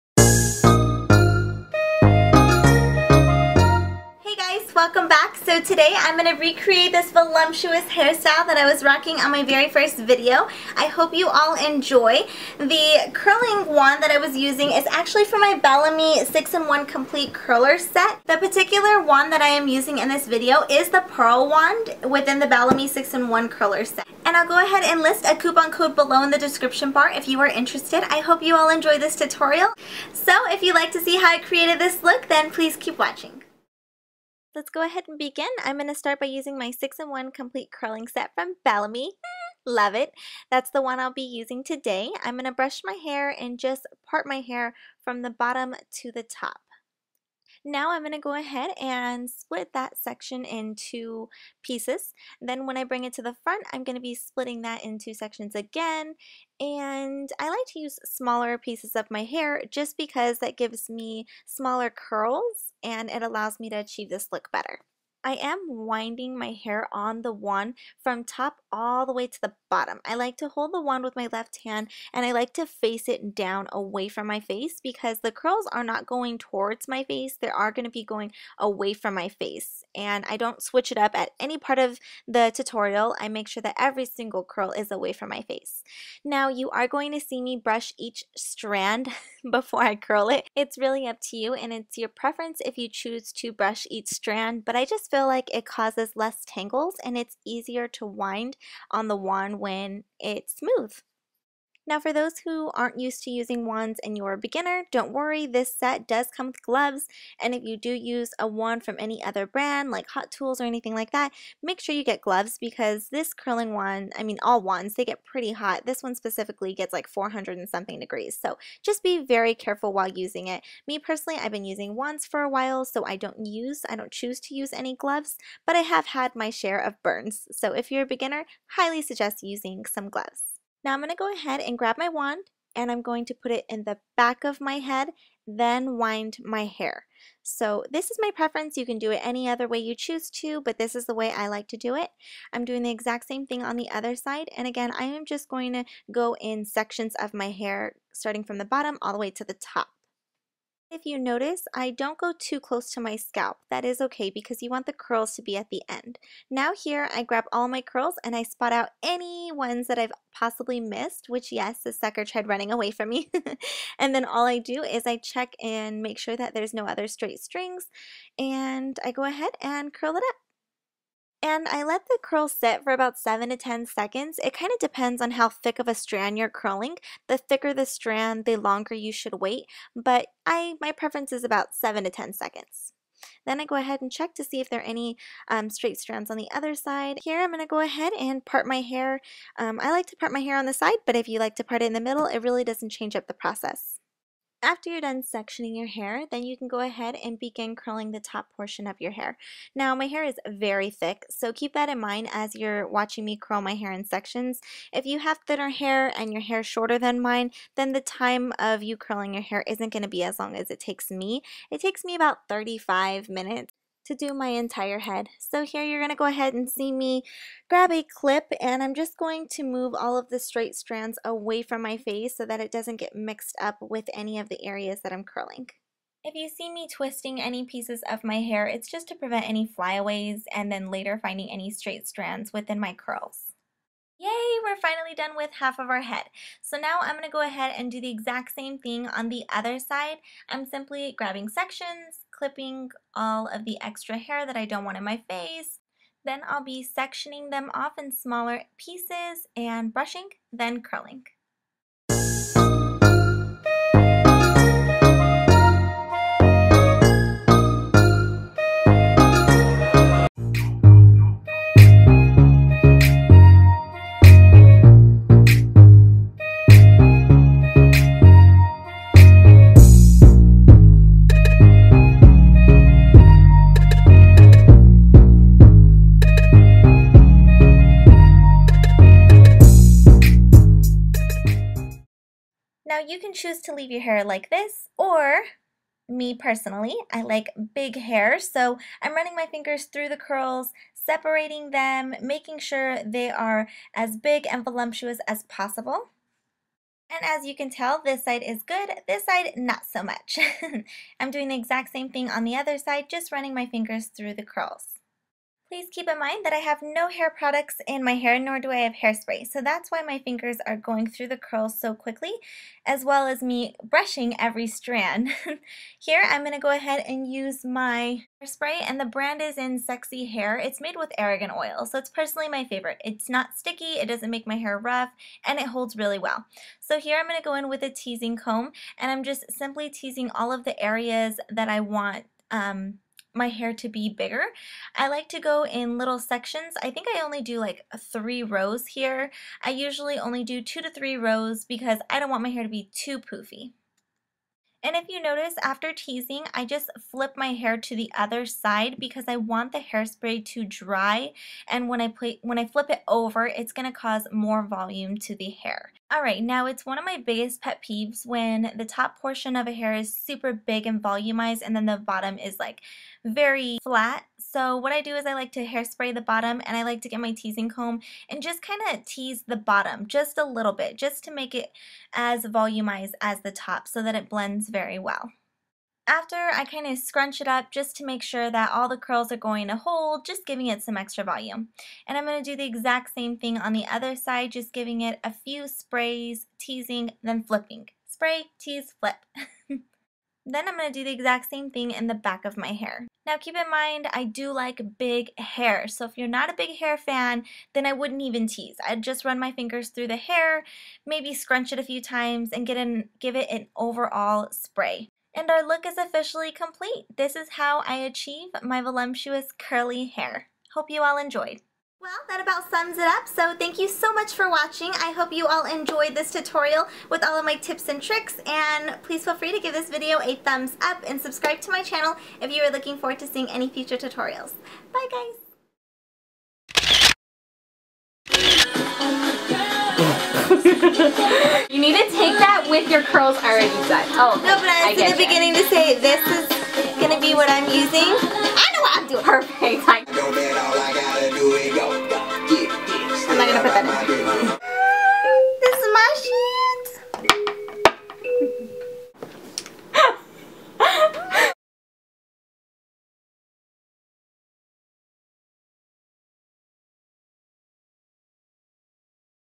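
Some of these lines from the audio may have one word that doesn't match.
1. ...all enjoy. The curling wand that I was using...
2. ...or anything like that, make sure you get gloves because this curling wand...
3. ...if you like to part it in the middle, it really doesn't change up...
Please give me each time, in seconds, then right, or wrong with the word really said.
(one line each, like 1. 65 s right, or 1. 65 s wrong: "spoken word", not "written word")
1. 11 s right
2. 110 s right
3. 191 s right.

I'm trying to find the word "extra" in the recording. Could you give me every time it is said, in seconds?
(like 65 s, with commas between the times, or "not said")
243 s, 380 s.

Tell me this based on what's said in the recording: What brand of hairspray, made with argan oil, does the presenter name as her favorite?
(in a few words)
Sexy Hair.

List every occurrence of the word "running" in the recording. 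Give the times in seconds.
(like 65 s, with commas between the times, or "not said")
162 s, 289 s, 303 s.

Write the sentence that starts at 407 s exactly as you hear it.
This is how I achieve my voluptuous curly hair.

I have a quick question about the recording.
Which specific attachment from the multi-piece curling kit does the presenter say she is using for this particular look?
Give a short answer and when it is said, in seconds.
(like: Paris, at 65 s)
Pearl Wand, at 21 s.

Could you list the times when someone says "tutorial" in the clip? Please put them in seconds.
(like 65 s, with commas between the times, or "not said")
29 s, 82 s, 416 s, 423 s.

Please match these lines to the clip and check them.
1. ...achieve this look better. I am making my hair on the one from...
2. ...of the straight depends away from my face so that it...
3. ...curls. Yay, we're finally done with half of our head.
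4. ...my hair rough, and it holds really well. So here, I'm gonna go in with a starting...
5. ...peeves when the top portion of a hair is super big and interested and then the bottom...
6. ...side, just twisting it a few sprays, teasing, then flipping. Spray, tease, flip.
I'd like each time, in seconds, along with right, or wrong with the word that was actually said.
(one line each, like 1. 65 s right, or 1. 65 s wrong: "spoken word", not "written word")
1. 63 s wrong: "winding", not "making"
2. 220 s wrong: "strands", not "depends"
3. 232 s right
4. 324 s wrong: "teasing", not "starting"
5. 357 s wrong: "volumized", not "interested"
6. 384 s wrong: "giving", not "twisting".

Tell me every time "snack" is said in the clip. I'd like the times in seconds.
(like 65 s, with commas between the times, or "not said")
not said.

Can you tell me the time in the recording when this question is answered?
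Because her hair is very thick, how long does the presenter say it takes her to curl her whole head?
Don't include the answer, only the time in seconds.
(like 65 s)
212 s.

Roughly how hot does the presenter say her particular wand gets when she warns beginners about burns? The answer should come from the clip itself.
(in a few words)
400 and something degrees.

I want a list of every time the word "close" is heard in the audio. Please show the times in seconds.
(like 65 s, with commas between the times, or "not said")
152 s.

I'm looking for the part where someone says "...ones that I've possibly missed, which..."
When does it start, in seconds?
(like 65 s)
159 s.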